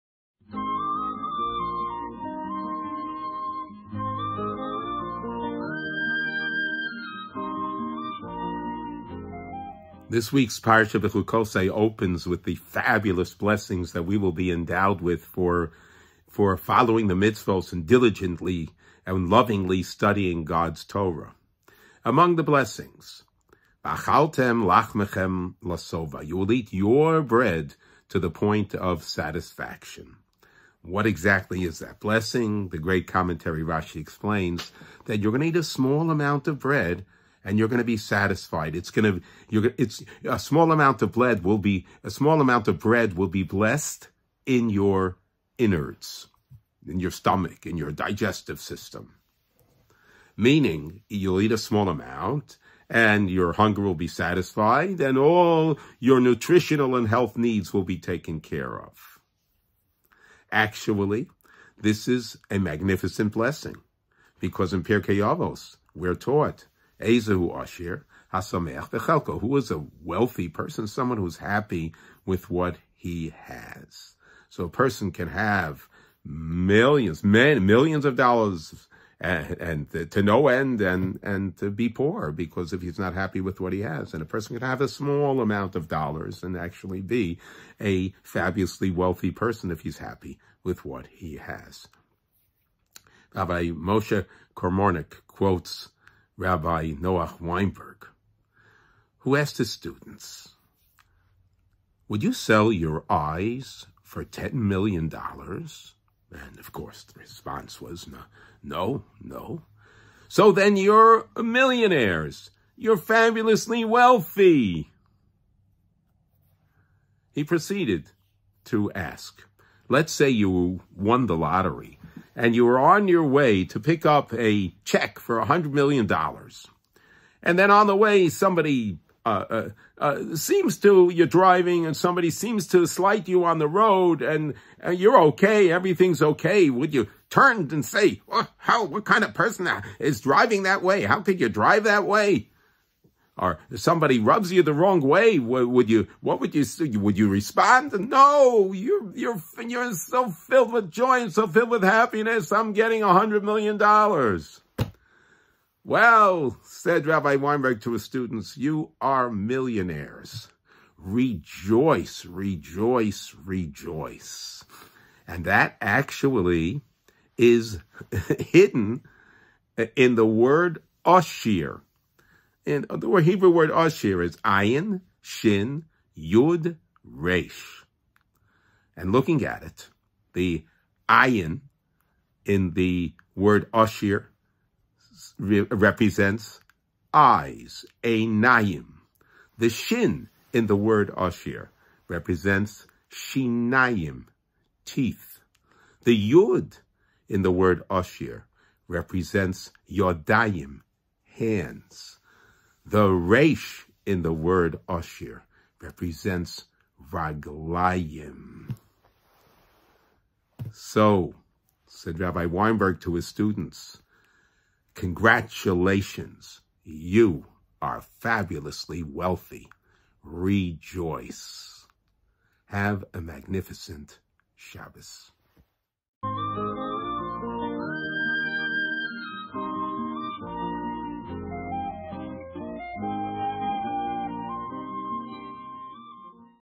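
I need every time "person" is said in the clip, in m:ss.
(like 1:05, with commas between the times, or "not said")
1:10, 1:14, 1:24, 1:29, 2:19.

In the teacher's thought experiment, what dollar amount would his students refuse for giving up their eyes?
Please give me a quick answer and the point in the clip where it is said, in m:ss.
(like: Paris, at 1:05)
$10 million, at 1:44.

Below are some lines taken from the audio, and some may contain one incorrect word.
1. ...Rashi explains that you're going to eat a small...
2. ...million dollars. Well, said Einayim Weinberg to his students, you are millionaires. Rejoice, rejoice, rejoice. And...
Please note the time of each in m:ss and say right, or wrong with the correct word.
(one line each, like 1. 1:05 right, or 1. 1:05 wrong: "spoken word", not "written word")
1. 0:33 right
2. 2:33 wrong: "Rabbi", not "Einayim".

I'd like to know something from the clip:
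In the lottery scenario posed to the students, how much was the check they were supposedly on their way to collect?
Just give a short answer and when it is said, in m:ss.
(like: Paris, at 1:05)
$100 million, at 2:05.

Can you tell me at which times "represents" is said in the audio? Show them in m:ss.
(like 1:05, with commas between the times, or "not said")
3:05, 3:12, 3:18, 3:25.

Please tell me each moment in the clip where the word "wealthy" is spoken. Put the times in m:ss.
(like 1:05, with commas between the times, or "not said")
1:10, 1:28, 1:53, 3:39.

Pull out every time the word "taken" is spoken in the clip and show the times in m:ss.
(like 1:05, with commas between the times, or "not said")
0:57.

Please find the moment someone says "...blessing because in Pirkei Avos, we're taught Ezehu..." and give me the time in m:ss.
1:03.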